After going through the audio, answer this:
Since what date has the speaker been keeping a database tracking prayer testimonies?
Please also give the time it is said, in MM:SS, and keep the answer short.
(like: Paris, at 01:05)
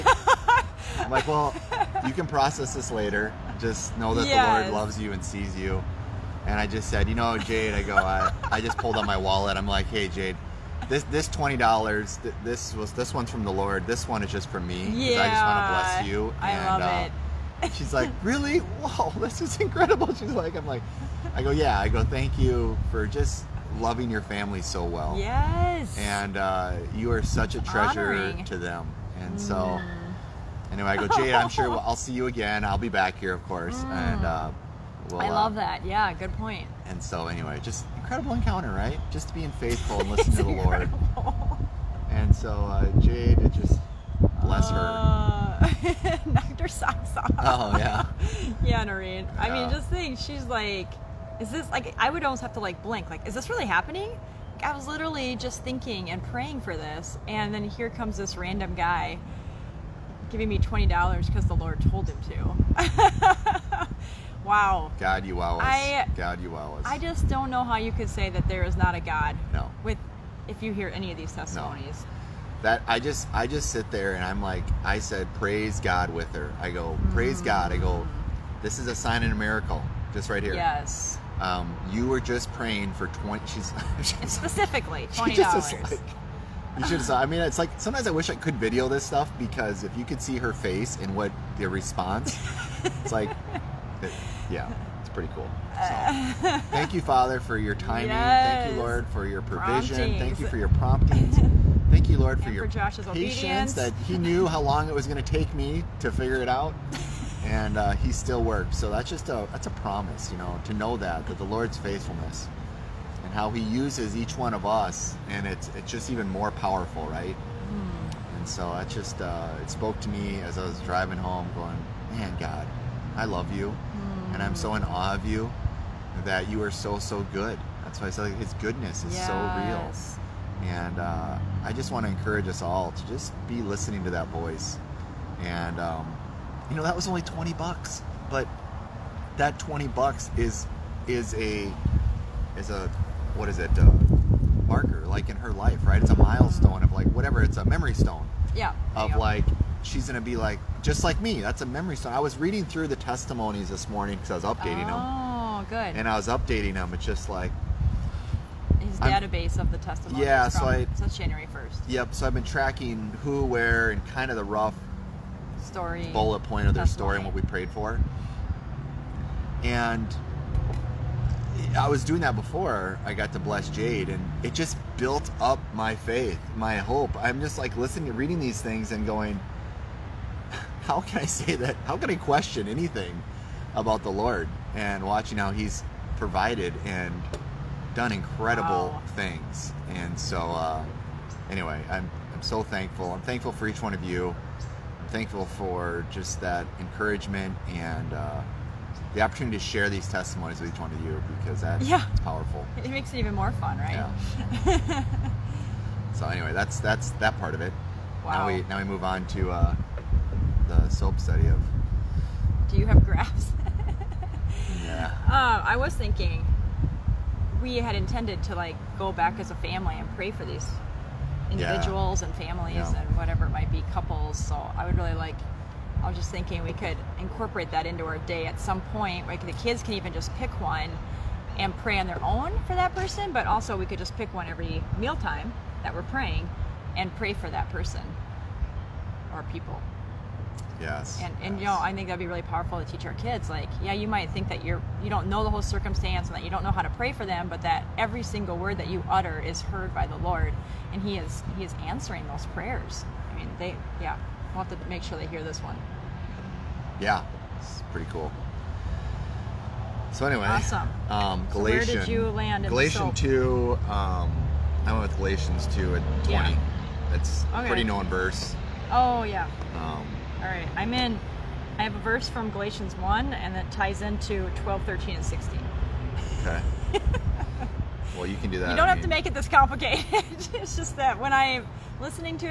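January 1st, at 02:41.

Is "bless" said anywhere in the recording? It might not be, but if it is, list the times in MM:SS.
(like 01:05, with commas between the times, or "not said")
00:15, 00:44, 02:53.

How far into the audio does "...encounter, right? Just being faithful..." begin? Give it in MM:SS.
00:38.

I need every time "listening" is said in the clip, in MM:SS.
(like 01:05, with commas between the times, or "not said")
00:40, 02:13, 02:57, 04:41.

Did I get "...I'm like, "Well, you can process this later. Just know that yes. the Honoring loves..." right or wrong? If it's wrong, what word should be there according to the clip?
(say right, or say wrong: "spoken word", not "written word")
wrong: "Lord", not "Honoring".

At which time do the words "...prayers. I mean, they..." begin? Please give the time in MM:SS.
04:12.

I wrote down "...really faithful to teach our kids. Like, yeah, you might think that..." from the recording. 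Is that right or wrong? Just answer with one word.
wrong.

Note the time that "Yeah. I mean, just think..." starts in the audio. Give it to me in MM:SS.
00:49.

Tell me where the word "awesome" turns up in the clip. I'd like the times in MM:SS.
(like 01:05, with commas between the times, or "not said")
04:20.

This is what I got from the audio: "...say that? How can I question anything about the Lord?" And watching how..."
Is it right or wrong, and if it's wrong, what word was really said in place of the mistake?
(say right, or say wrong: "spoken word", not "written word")
right.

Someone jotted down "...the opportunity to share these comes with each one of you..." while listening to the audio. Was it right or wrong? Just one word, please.
wrong.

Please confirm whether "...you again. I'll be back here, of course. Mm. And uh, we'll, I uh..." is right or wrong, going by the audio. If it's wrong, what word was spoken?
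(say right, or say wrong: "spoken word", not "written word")
right.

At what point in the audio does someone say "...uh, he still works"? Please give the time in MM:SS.
01:47.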